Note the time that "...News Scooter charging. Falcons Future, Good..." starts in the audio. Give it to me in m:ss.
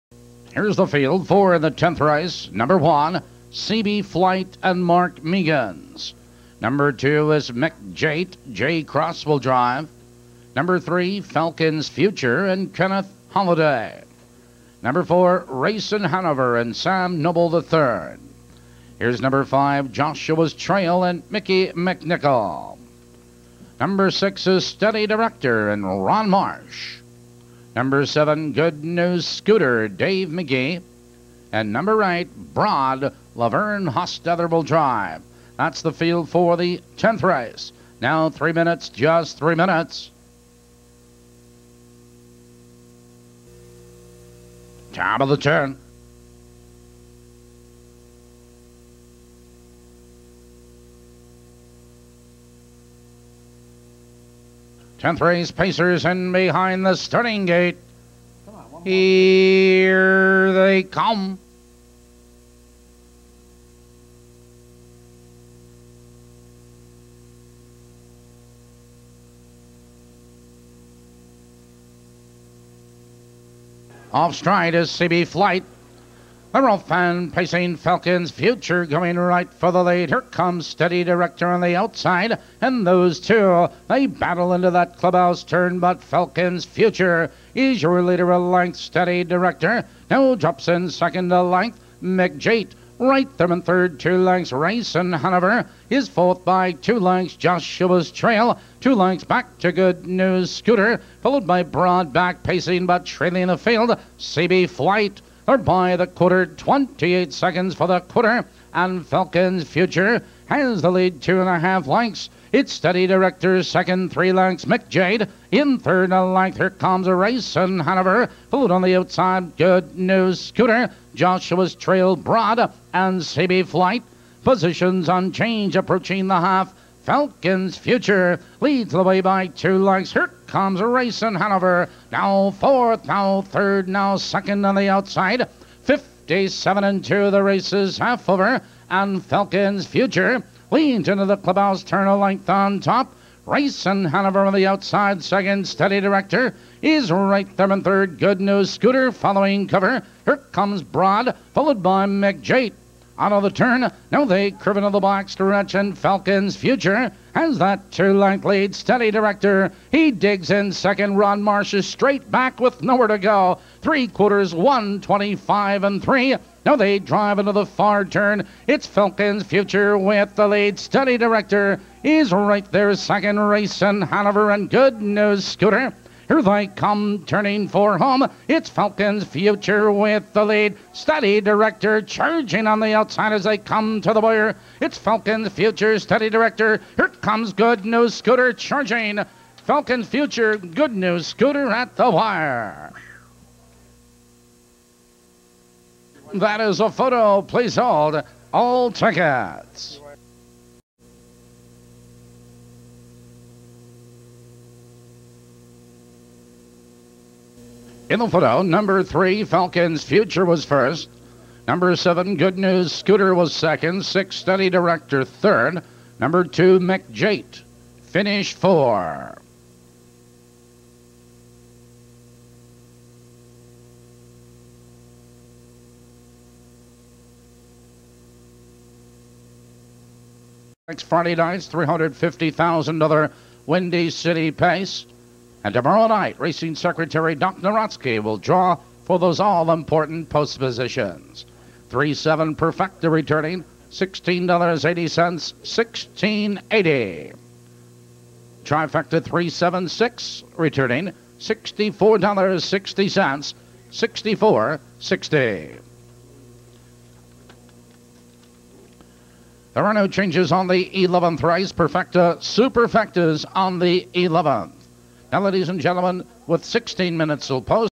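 3:07.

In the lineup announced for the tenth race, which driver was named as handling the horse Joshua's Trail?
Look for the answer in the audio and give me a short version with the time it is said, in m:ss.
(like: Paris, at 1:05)
Mickey McNichol, at 0:21.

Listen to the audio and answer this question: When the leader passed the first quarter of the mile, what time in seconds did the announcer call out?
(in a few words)
28 seconds.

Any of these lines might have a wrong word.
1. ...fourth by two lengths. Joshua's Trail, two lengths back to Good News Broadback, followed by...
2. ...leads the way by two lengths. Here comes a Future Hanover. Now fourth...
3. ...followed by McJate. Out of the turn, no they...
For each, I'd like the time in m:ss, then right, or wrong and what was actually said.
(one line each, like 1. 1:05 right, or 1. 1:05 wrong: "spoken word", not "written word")
1. 1:36 wrong: "Scooter", not "Broadback"
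2. 2:08 wrong: "Racing", not "Future"
3. 2:31 right.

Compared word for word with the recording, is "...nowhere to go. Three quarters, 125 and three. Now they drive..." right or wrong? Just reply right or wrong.
right.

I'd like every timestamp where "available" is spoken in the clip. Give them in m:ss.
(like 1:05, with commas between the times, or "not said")
not said.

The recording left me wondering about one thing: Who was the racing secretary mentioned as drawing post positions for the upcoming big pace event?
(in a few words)
Doc Narotsky.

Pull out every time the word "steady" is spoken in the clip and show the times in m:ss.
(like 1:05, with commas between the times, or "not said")
0:24, 1:20, 1:28, 1:52, 2:25, 2:38, 2:50.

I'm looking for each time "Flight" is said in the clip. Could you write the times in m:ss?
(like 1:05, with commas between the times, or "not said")
0:04, 1:15, 1:44, 2:03.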